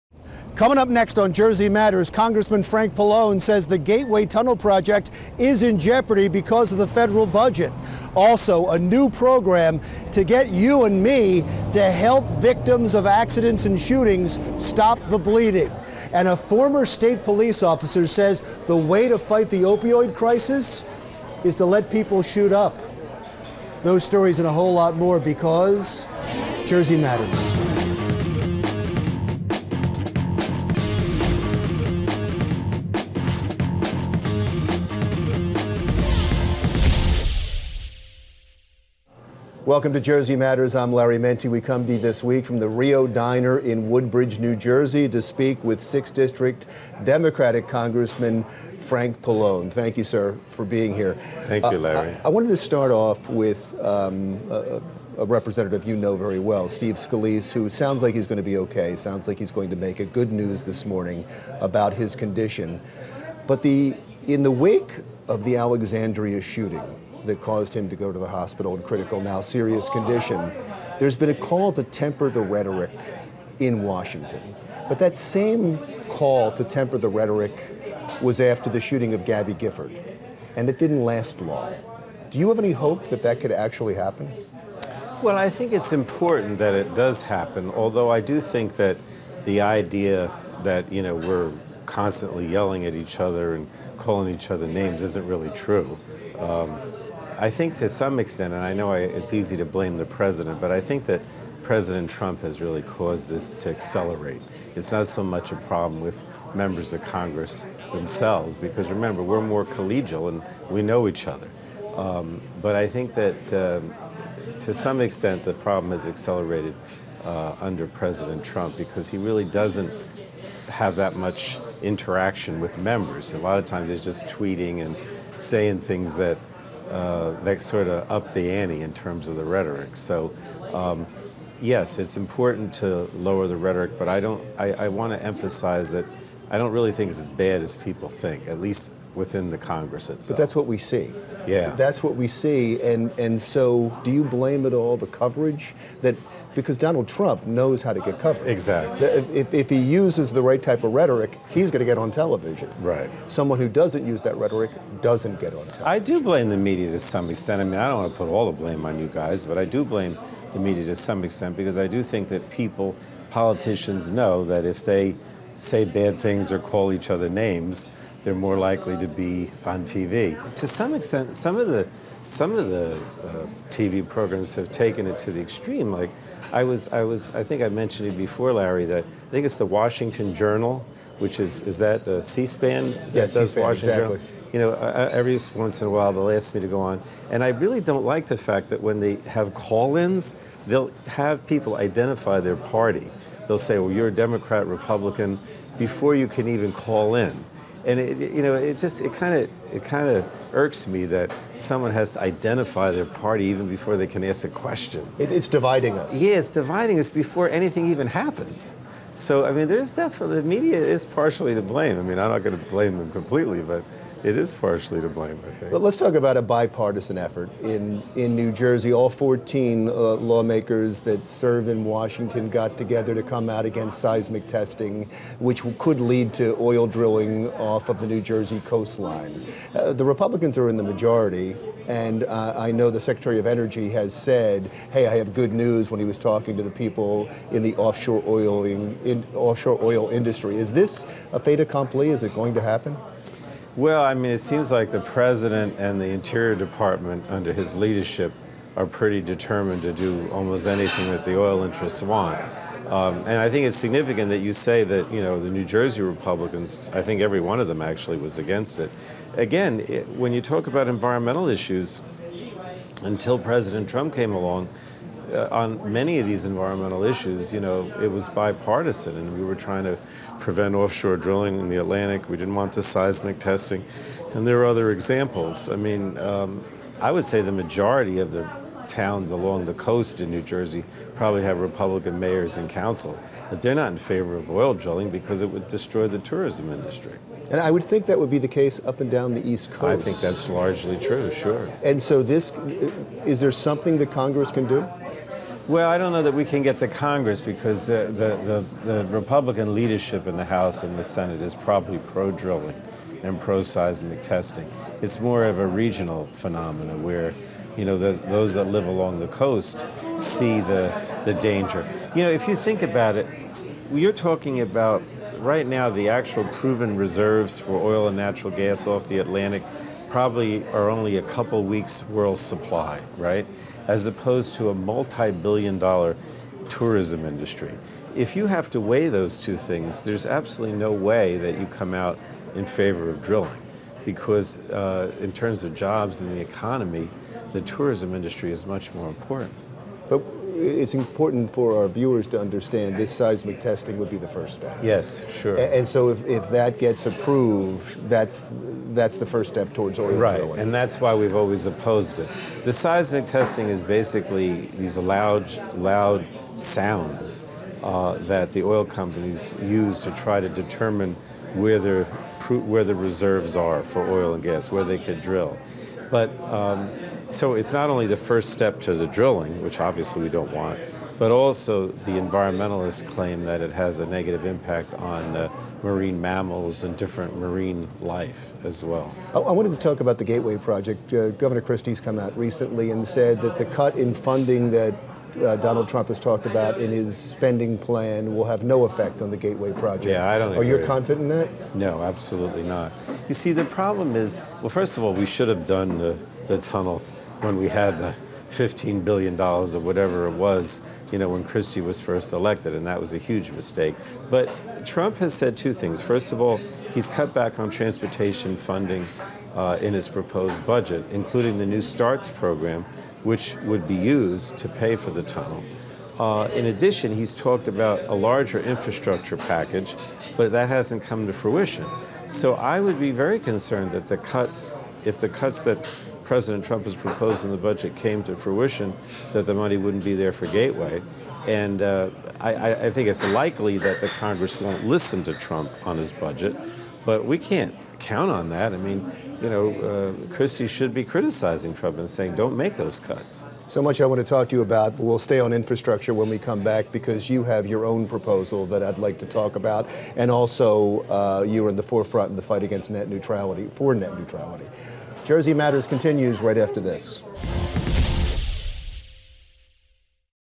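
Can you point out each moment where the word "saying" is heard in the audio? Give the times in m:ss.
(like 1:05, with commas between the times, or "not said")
2:05, 7:22.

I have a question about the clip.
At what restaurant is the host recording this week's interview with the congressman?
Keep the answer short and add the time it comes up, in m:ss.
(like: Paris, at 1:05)
Rio Diner, at 0:42.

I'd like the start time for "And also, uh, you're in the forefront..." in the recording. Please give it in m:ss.
7:30.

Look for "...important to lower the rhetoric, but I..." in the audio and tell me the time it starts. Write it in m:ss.
2:12.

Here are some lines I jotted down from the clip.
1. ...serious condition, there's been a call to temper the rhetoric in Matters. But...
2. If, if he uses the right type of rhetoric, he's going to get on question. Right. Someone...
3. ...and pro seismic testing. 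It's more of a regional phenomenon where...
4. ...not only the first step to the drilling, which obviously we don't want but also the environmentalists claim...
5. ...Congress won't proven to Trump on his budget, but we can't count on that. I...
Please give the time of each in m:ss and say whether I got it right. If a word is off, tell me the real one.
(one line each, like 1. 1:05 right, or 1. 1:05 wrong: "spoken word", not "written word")
1. 1:09 wrong: "Washington", not "Matters"
2. 2:29 wrong: "television", not "question"
3. 5:03 right
4. 6:07 right
5. 7:14 wrong: "listen", not "proven".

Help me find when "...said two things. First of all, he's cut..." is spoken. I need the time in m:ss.
6:45.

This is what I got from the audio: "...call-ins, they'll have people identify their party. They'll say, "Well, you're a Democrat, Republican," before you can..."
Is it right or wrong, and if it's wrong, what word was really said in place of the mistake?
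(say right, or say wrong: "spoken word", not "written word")
right.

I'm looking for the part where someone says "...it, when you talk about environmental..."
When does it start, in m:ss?
4:19.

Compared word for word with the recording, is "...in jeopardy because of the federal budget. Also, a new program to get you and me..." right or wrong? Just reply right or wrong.
right.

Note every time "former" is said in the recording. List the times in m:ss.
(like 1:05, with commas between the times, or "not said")
0:16.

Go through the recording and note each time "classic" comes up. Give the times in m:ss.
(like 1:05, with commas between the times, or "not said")
not said.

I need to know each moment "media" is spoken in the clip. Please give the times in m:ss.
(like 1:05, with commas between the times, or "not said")
2:36, 2:40, 3:30.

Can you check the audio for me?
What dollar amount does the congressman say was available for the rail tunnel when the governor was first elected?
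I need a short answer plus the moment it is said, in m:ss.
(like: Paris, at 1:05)
$15 billion, at 6:38.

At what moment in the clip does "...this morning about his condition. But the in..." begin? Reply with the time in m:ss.
1:00.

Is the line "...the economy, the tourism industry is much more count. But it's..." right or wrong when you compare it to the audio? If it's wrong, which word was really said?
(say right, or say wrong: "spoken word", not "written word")
wrong: "important", not "count".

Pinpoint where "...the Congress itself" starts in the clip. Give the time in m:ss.
2:19.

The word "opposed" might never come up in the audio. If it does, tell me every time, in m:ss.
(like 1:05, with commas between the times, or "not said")
5:24, 5:51.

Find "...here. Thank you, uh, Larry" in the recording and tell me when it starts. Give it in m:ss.
0:50.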